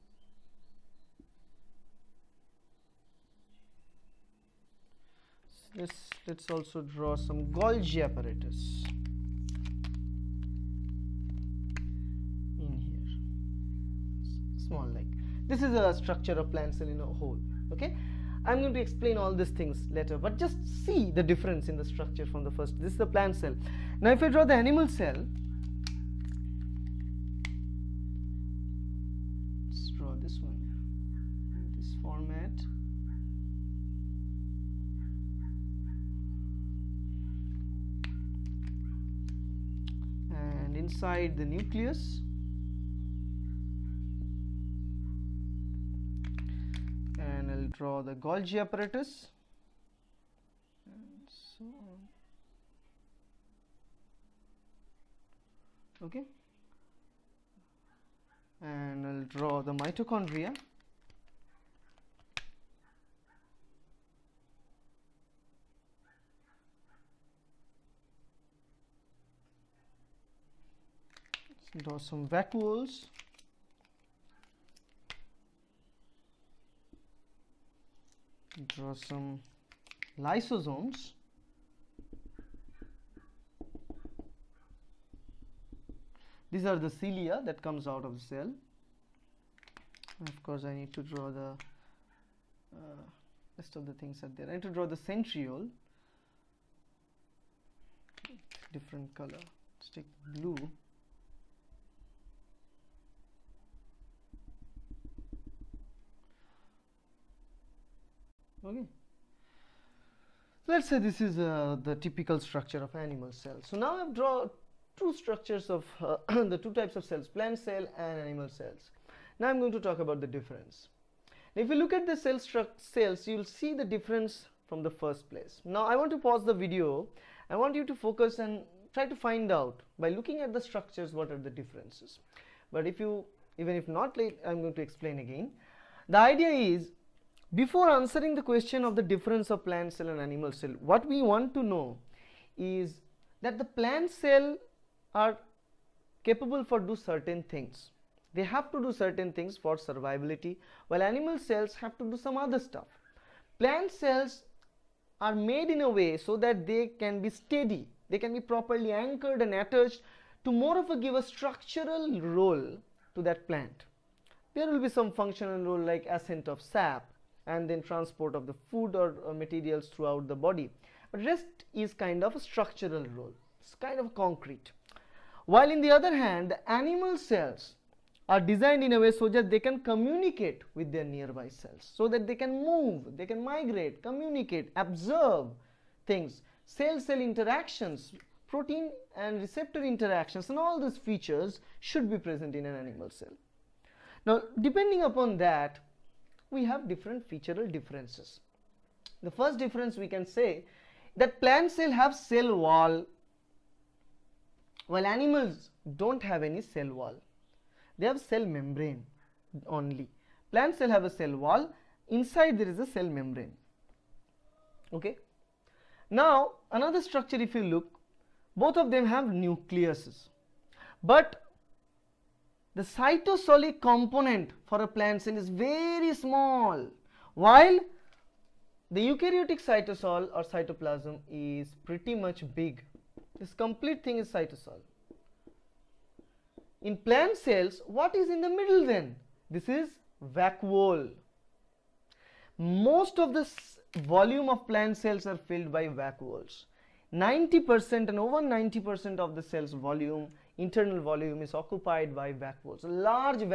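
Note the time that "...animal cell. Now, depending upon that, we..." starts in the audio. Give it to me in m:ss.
3:12.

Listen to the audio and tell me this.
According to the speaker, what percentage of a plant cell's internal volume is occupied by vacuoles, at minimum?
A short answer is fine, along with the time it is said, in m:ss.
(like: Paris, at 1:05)
over 90%, at 4:08.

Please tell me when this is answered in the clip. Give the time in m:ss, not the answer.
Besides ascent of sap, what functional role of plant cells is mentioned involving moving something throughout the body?
2:47.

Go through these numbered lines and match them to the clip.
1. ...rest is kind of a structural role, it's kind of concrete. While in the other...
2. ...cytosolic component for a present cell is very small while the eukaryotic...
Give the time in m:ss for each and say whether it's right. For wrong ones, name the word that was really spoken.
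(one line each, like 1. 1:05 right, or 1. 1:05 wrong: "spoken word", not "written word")
1. 2:51 right
2. 3:42 wrong: "plant", not "present".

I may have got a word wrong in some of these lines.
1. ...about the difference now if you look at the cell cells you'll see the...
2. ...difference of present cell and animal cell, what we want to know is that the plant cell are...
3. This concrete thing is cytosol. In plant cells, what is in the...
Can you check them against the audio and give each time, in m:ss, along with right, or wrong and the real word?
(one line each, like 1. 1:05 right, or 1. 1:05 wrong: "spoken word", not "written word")
1. 1:59 right
2. 2:19 wrong: "plant", not "present"
3. 3:53 wrong: "complete", not "concrete".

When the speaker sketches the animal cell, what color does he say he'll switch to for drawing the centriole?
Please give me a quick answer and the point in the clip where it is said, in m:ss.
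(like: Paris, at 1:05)
blue, at 1:40.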